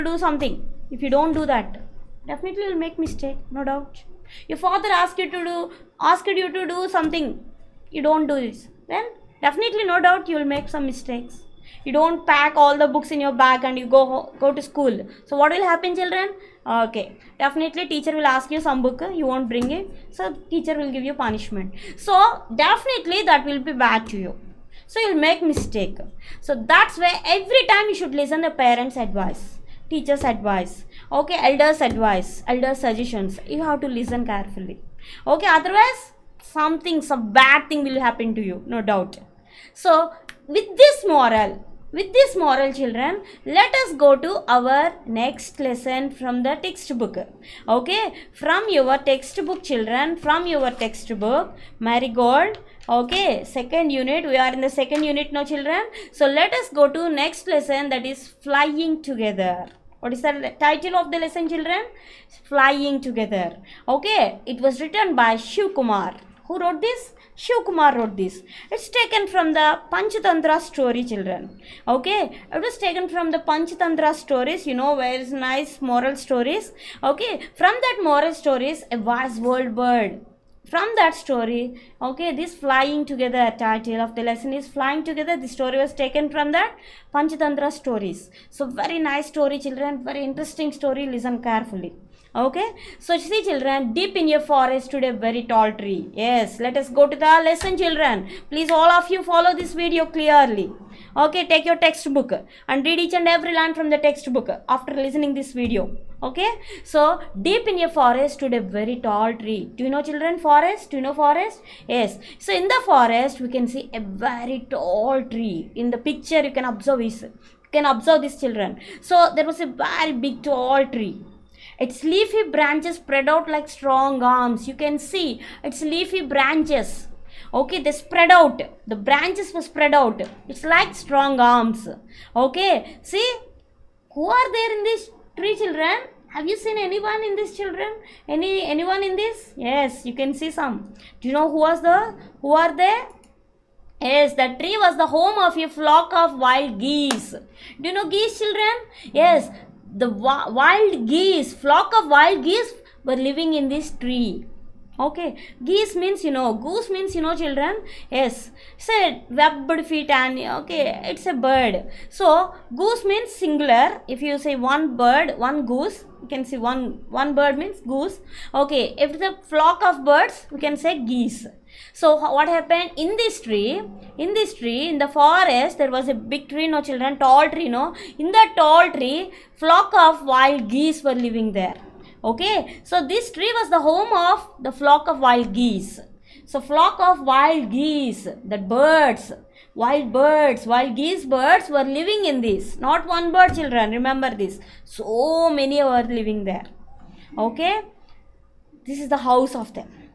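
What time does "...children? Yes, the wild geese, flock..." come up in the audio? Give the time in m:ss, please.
2:28.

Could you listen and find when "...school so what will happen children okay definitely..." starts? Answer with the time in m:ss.
0:14.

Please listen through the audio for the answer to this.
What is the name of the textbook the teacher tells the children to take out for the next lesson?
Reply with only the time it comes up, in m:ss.
0:51.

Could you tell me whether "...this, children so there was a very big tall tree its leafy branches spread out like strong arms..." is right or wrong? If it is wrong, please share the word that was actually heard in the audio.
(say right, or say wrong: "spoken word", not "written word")
right.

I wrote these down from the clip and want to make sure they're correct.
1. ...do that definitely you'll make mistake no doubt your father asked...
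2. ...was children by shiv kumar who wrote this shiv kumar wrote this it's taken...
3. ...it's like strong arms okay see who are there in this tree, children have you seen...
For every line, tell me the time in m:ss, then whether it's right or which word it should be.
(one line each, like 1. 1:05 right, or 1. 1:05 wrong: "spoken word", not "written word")
1. 0:01 right
2. 1:04 wrong: "written", not "children"
3. 2:10 right.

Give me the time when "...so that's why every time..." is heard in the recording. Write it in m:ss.
0:26.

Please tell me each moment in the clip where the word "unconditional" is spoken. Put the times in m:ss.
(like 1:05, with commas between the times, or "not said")
not said.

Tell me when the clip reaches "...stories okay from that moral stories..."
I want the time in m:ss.
1:16.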